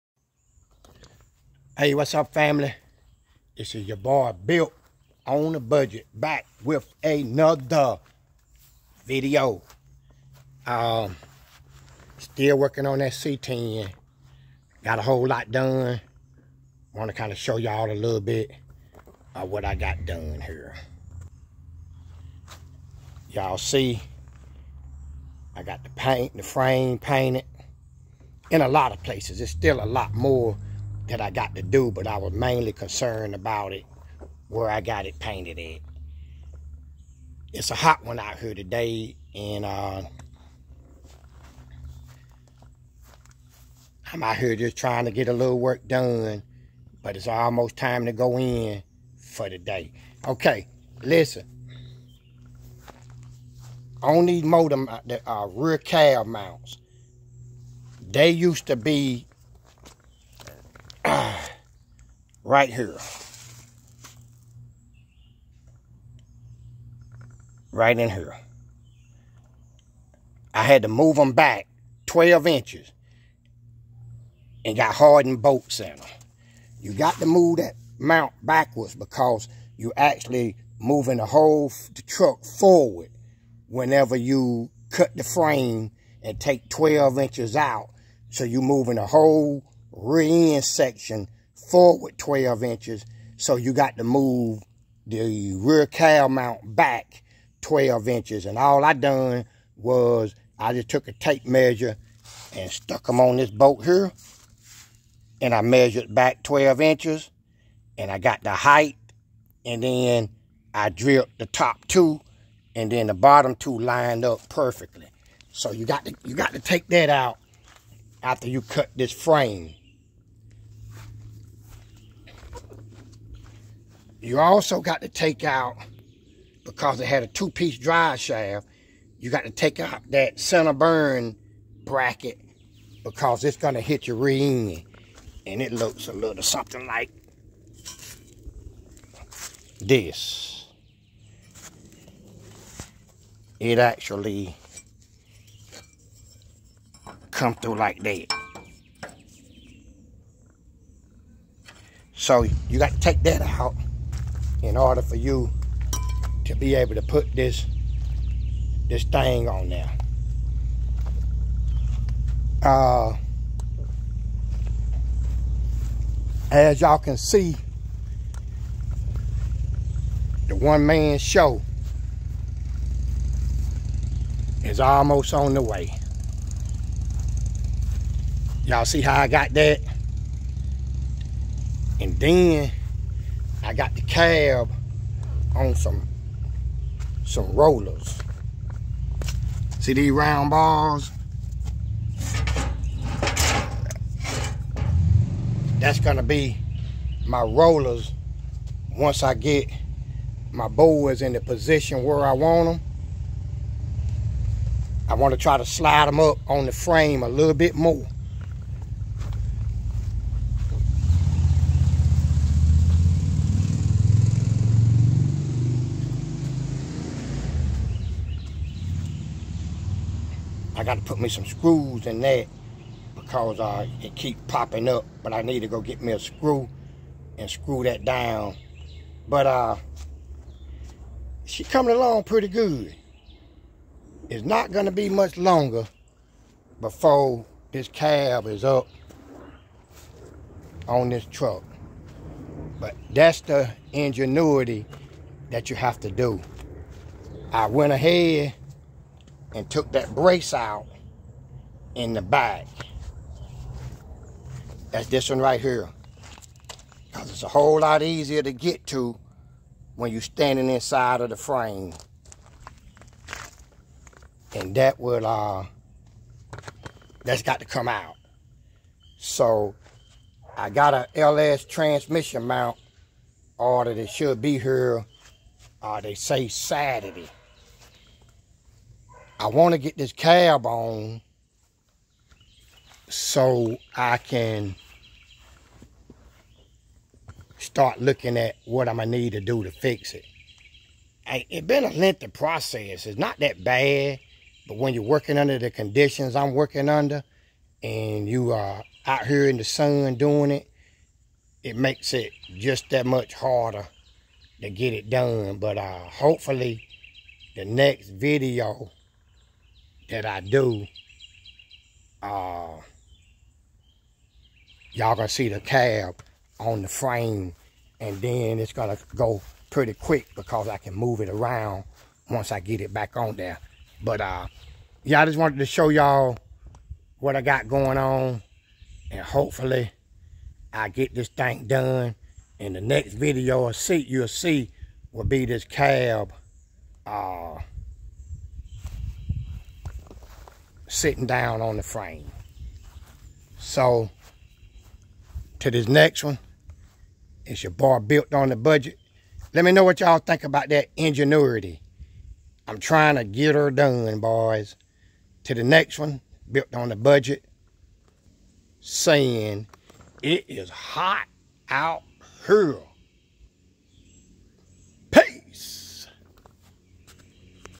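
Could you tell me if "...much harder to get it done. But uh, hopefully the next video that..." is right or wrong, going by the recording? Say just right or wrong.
right.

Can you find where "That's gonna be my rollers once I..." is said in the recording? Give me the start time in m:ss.
3:15.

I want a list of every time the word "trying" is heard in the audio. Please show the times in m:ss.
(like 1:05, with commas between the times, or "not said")
0:44, 5:52.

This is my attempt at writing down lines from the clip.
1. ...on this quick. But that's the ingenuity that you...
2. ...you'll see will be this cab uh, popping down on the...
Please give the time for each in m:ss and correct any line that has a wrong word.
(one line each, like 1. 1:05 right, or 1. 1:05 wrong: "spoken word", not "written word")
1. 4:00 wrong: "truck", not "quick"
2. 5:34 wrong: "sitting", not "popping".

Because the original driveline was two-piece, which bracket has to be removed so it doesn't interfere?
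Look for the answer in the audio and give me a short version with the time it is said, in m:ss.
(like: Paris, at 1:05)
center bearing bracket, at 2:10.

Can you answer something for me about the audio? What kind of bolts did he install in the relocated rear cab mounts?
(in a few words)
hardened bolts.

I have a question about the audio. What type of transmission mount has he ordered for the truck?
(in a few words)
LS transmission mount.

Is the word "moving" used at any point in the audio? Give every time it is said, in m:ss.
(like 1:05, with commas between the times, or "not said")
1:20, 1:28.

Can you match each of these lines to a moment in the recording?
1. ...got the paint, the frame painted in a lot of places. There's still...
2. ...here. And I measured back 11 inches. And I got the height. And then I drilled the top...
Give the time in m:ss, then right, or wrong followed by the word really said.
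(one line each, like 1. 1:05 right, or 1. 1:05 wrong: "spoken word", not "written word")
1. 0:25 right
2. 1:43 wrong: "12", not "11".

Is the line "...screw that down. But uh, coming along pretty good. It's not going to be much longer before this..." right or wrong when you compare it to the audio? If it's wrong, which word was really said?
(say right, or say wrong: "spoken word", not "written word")
right.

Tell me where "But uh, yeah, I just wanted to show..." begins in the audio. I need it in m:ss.
5:24.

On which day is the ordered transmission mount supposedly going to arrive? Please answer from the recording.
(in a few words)
Saturday.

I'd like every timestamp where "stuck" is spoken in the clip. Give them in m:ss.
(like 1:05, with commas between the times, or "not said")
1:42.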